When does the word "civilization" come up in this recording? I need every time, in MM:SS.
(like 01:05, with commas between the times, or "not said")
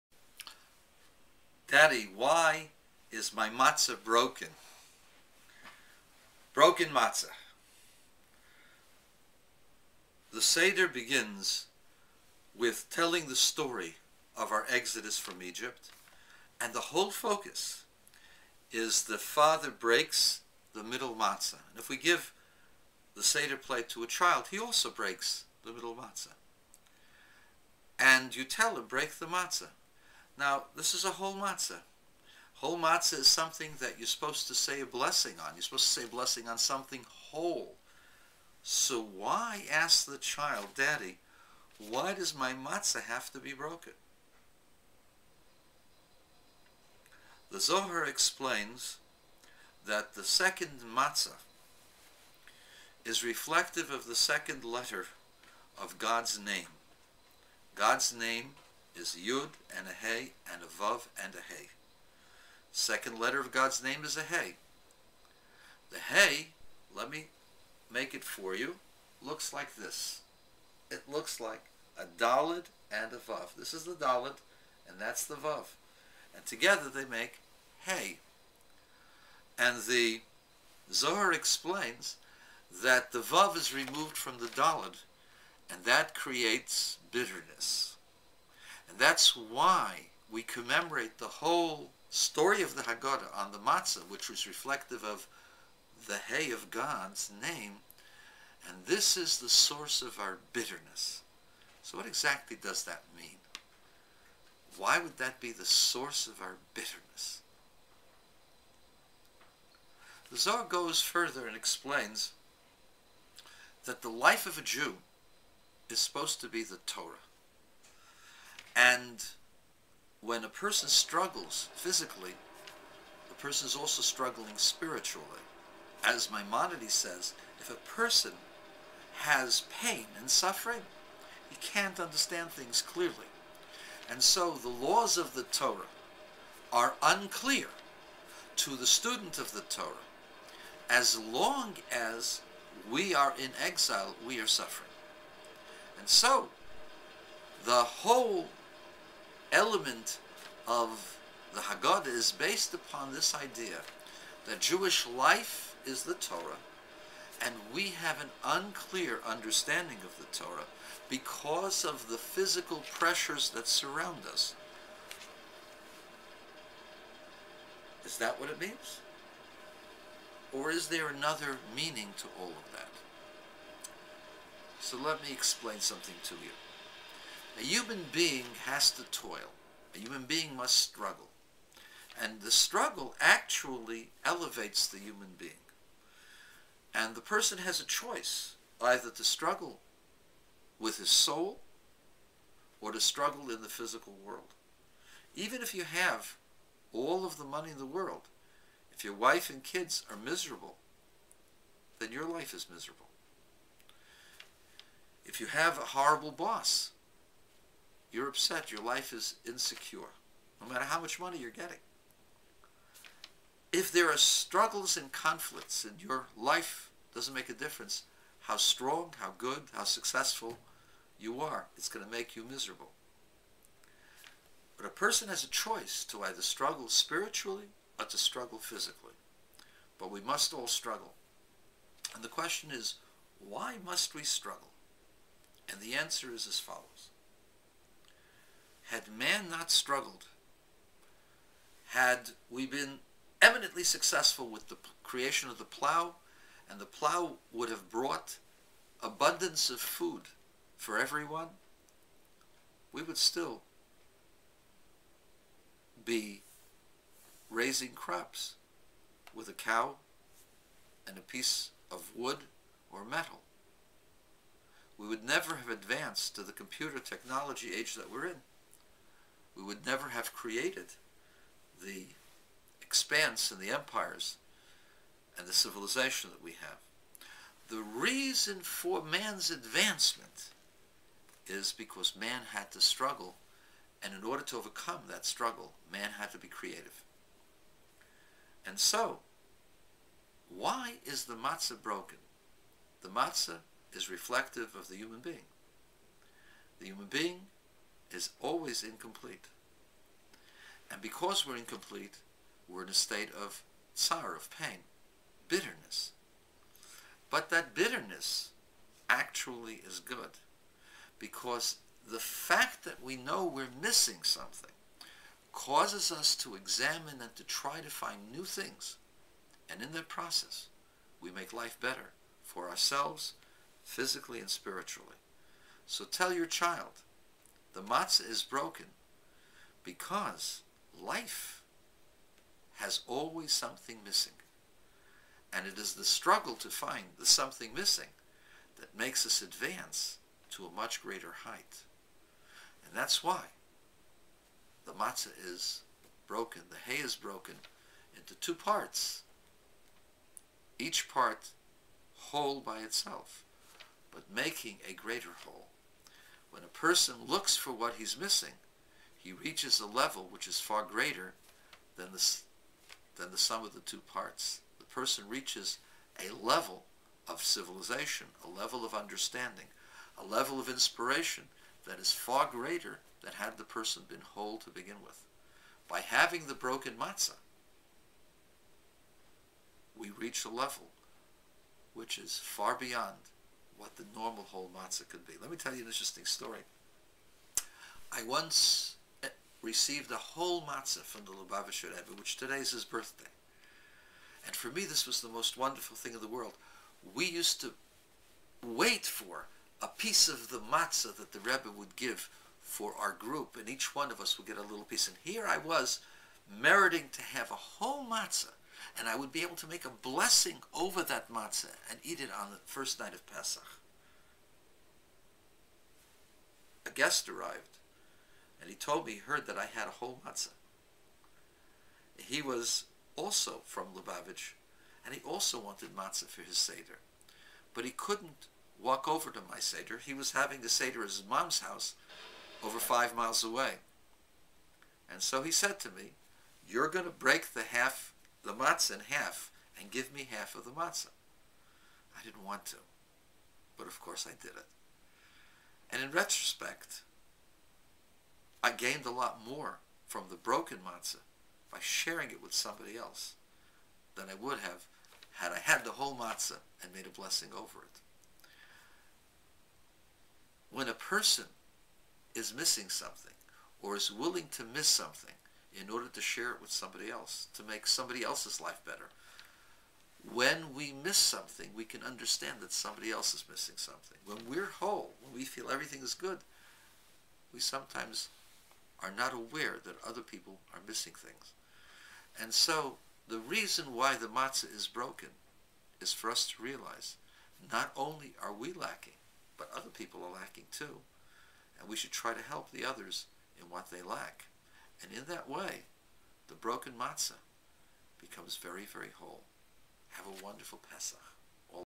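04:35, 06:07.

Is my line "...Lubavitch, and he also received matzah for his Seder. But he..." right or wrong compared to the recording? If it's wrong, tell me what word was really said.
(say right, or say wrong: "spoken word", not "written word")
wrong: "wanted", not "received".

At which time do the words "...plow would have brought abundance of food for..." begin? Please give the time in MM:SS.
04:06.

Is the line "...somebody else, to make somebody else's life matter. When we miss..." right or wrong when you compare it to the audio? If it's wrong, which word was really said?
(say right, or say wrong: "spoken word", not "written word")
wrong: "better", not "matter".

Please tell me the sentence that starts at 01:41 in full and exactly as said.
So what exactly does that mean?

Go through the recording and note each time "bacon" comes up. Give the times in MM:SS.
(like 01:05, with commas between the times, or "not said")
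not said.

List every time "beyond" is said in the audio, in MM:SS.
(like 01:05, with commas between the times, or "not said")
06:22.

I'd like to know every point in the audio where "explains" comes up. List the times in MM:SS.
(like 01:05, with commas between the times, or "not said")
00:48, 01:21, 01:51, 02:55.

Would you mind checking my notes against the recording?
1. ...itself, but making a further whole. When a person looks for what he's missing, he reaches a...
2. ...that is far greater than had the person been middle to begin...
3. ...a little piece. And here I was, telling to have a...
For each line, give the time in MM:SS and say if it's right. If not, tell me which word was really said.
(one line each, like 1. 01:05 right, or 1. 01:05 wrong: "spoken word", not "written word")
1. 05:52 wrong: "greater", not "further"
2. 06:11 wrong: "whole", not "middle"
3. 06:44 wrong: "meriting", not "telling".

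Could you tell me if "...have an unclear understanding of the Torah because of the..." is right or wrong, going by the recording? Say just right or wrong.
right.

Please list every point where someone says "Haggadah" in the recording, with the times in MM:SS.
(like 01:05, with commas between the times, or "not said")
01:32, 02:31.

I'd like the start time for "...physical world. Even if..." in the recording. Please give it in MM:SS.
03:13.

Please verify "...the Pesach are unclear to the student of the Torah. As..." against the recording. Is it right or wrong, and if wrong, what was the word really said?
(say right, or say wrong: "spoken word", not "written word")
wrong: "Torah", not "Pesach".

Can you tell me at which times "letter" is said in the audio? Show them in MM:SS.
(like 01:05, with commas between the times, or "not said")
00:54, 01:03.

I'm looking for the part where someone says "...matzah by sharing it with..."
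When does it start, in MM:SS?
07:30.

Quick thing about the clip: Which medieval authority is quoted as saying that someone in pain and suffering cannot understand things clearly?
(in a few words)
Maimonides.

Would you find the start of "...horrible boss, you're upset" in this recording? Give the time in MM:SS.
03:25.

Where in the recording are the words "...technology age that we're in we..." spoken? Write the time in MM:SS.
04:26.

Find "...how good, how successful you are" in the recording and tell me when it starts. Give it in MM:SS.
03:39.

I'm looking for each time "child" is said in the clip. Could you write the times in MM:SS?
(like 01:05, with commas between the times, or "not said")
00:24, 00:40, 05:26.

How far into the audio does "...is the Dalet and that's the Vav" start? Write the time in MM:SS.
01:13.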